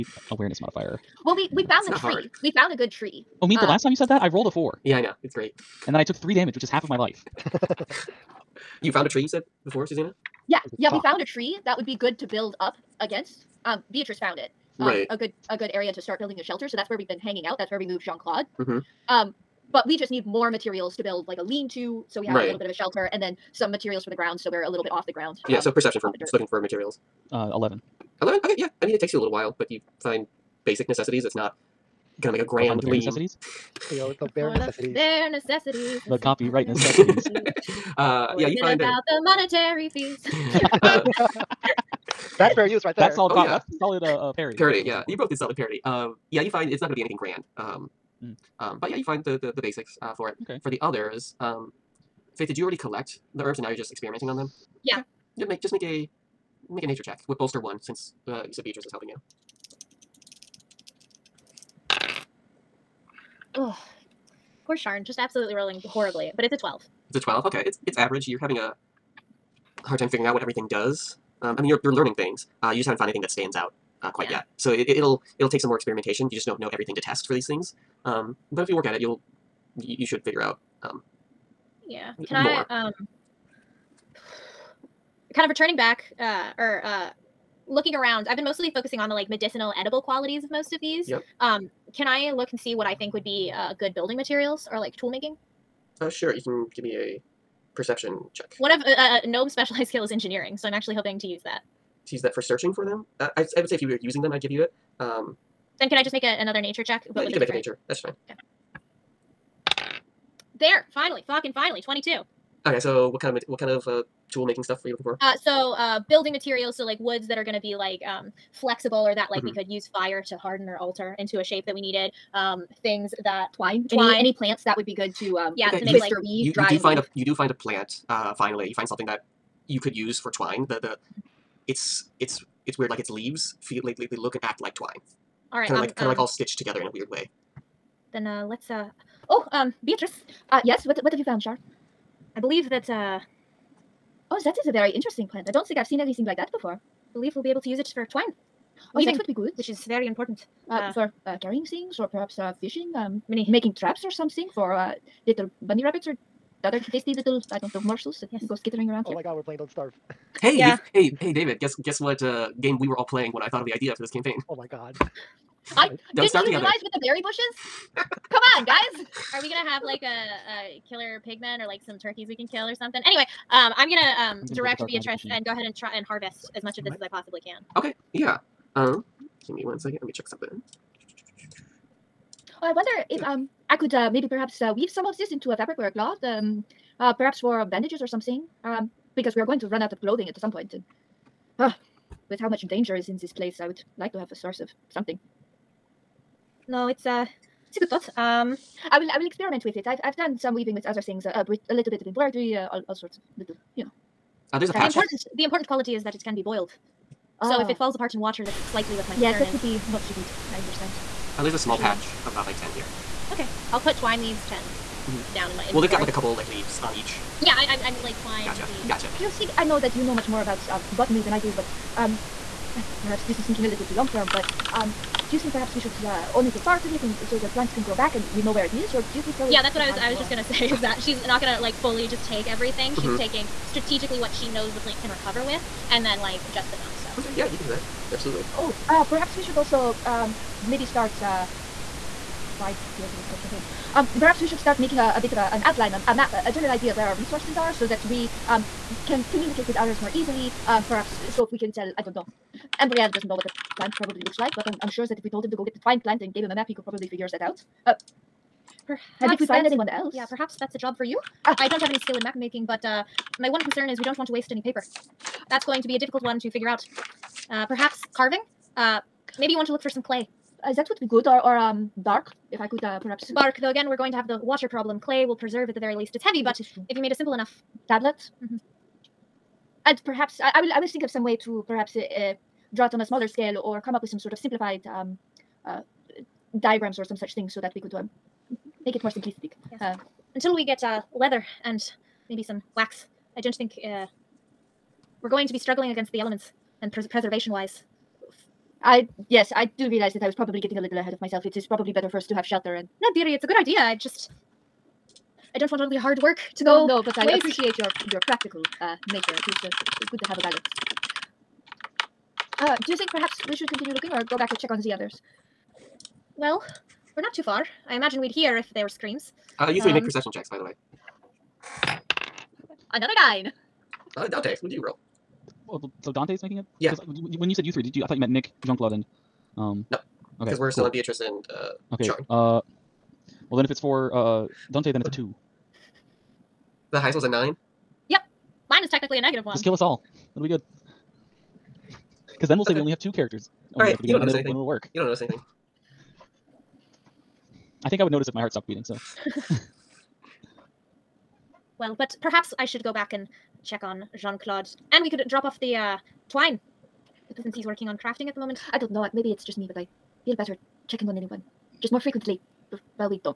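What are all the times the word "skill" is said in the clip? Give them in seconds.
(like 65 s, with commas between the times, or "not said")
99 s, 261 s.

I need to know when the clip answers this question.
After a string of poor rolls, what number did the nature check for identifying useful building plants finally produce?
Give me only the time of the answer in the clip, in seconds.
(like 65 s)
111 s.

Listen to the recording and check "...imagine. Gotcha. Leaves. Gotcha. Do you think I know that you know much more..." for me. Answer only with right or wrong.
wrong.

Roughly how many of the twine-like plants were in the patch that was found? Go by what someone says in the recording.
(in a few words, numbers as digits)
10.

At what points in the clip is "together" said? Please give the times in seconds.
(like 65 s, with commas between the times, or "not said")
136 s, 166 s.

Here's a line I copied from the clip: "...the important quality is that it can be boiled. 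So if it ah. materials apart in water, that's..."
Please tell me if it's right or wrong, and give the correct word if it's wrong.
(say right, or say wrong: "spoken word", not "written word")
wrong: "falls", not "materials".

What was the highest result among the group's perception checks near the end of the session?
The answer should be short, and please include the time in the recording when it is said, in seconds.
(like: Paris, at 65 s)
9, at 336 s.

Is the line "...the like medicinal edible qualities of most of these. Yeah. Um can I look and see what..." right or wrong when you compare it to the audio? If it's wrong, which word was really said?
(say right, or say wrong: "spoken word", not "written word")
right.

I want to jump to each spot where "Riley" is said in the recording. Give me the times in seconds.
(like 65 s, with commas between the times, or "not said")
not said.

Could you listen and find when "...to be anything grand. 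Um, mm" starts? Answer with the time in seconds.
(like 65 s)
46 s.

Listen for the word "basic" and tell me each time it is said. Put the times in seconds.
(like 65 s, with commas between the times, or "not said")
30 s, 49 s.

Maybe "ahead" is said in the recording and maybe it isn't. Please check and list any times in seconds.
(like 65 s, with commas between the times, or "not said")
175 s, 300 s.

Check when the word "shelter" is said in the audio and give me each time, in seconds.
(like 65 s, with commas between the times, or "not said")
16 s, 22 s, 302 s.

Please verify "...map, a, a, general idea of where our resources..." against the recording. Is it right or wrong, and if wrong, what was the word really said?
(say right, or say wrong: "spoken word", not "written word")
right.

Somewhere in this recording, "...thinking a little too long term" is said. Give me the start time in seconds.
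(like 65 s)
223 s.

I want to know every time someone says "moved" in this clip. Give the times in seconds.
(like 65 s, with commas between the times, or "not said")
17 s.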